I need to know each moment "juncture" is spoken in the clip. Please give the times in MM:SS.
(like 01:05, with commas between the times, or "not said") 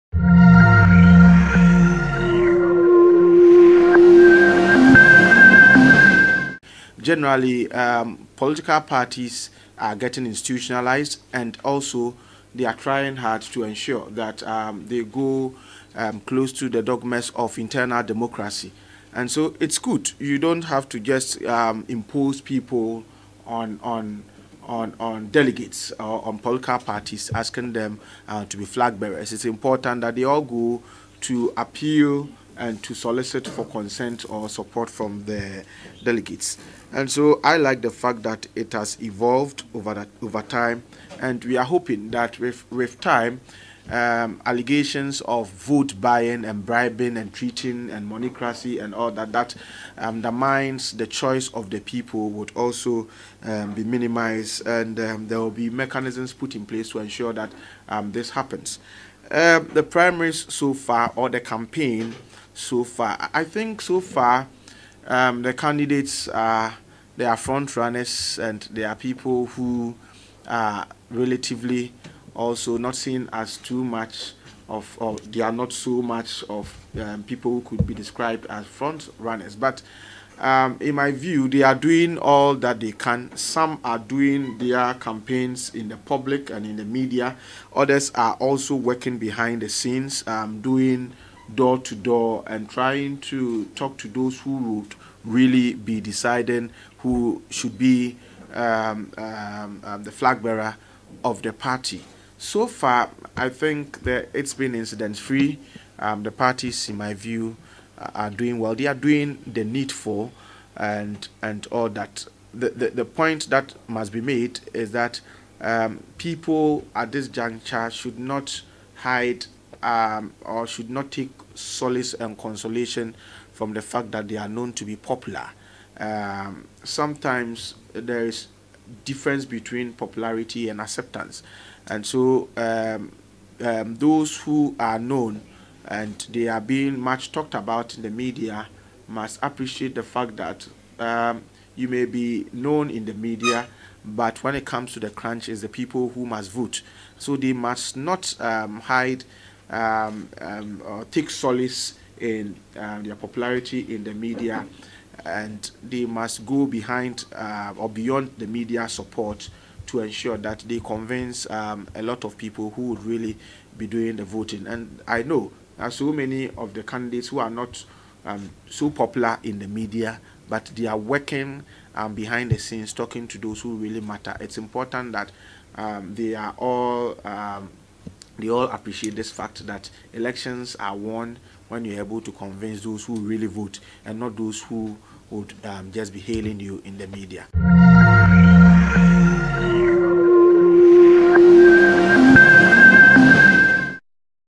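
01:57.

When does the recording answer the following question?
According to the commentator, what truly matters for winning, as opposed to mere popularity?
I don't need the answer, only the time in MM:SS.
02:10.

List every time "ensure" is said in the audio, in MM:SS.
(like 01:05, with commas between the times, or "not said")
00:13, 00:56, 02:40.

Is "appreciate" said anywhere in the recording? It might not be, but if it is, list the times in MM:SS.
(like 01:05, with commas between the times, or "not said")
02:19, 02:58.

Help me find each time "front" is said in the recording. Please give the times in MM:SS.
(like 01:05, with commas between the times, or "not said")
01:07, 01:18.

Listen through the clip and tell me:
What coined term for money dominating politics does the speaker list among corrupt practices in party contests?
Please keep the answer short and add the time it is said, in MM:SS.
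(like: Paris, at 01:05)
moneycracy, at 00:48.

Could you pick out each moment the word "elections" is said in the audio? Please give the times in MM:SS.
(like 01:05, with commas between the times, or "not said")
03:00.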